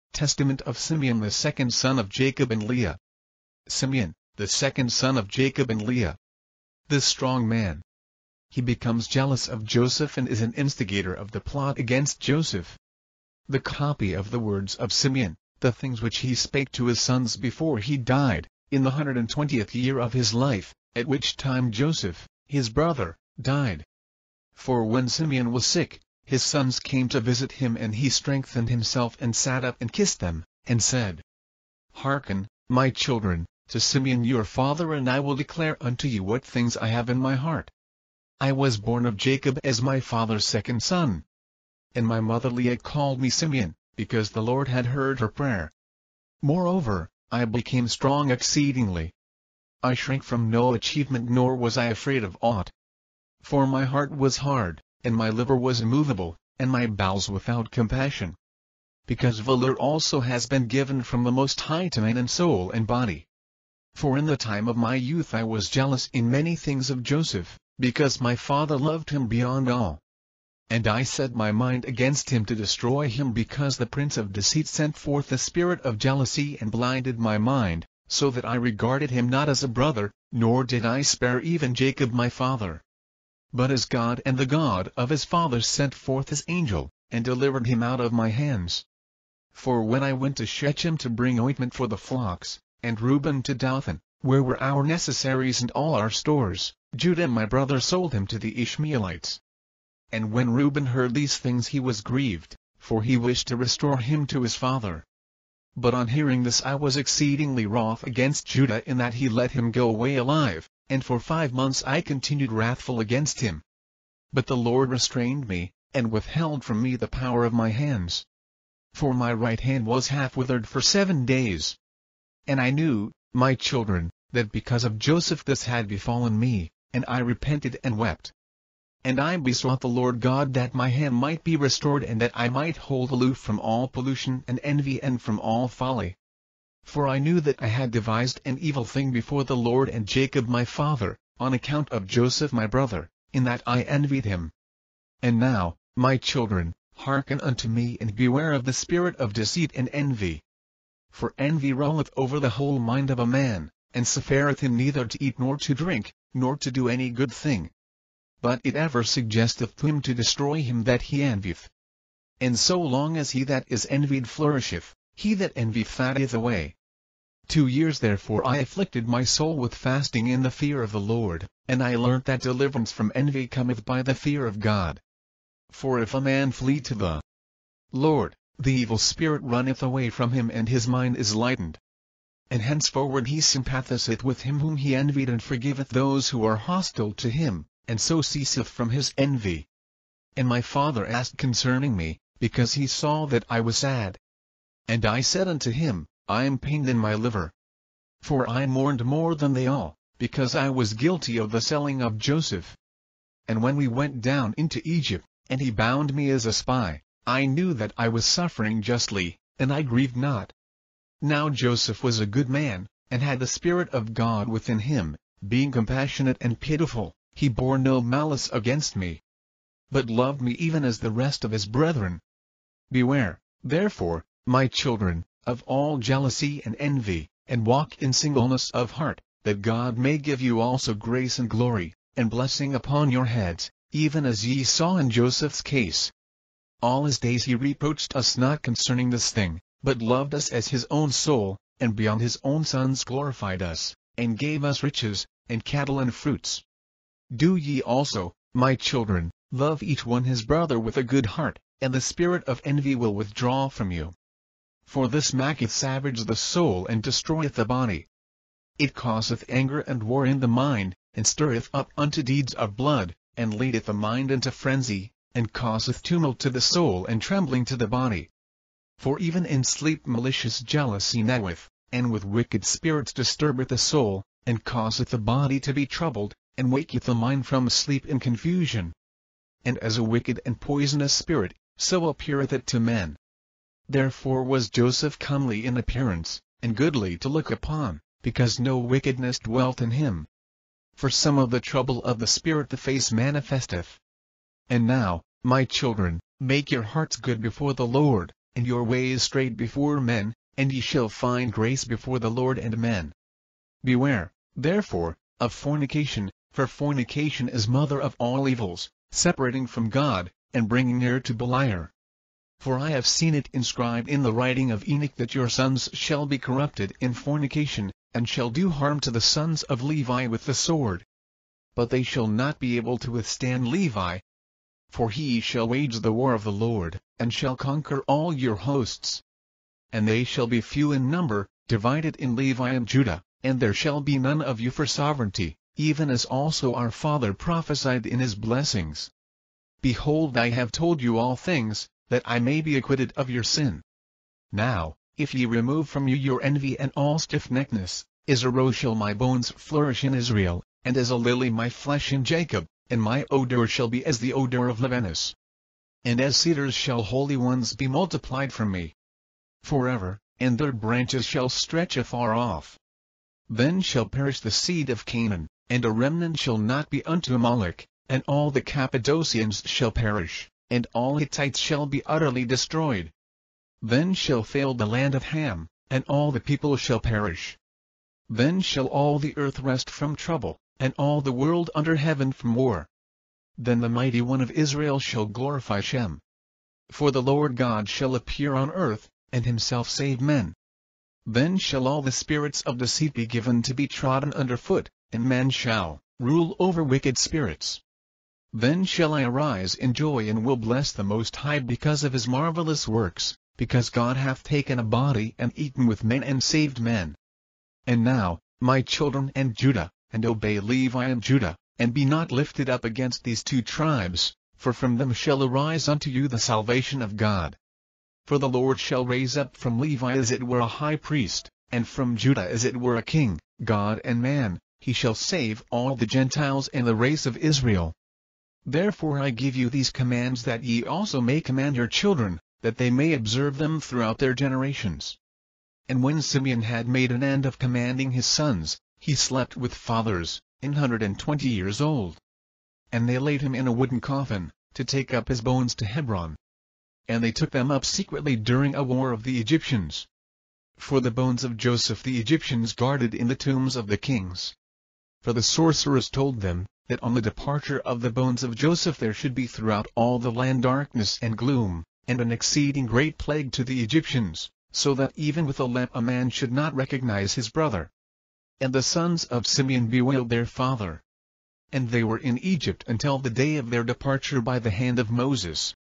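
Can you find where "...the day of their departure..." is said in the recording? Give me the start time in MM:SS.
07:53.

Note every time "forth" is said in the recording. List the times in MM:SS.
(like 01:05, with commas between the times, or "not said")
01:14, 01:25.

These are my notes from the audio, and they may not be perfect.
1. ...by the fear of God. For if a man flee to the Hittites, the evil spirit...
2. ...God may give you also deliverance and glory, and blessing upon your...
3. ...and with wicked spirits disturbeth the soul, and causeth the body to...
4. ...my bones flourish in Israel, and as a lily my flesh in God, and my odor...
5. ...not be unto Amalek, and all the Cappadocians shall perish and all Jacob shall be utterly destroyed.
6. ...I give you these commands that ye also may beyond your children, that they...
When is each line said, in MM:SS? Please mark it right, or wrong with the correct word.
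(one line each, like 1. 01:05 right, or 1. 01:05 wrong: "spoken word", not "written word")
1. 02:53 wrong: "Lord", not "Hittites"
2. 03:49 wrong: "grace", not "deliverance"
3. 04:31 right
4. 05:48 wrong: "Jacob", not "God"
5. 06:06 wrong: "Hittites", not "Jacob"
6. 07:09 wrong: "command", not "beyond".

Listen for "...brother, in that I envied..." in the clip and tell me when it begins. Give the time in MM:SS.
02:22.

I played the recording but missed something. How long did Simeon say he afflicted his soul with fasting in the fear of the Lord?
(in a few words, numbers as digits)
2 years.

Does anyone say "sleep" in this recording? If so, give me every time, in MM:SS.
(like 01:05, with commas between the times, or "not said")
04:29, 04:37.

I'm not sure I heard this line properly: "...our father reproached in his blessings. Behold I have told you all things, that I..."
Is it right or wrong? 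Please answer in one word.
wrong.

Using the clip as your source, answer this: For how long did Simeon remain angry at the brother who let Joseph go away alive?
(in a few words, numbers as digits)
5 months.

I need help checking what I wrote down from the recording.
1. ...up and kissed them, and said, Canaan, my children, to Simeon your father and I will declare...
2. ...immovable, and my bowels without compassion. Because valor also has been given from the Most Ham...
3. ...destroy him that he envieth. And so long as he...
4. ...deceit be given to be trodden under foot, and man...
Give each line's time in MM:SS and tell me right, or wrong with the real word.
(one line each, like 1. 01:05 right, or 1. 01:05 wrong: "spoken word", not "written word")
1. 00:29 wrong: "Hearken", not "Canaan"
2. 00:55 wrong: "High", not "Ham"
3. 02:40 right
4. 06:32 right.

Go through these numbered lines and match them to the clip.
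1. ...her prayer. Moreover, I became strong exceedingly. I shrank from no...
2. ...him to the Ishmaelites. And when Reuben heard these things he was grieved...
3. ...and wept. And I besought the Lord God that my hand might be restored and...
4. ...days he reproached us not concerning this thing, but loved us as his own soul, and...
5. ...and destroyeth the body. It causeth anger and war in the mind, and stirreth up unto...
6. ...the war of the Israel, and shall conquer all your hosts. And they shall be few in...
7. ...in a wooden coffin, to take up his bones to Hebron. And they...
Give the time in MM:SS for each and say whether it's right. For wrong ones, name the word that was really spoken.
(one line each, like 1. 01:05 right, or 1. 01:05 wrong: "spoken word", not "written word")
1. 00:45 right
2. 01:38 right
3. 02:07 right
4. 03:57 right
5. 04:16 right
6. 05:26 wrong: "Lord", not "Israel"
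7. 07:23 right.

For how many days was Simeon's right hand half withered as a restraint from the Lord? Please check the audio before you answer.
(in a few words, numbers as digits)
7.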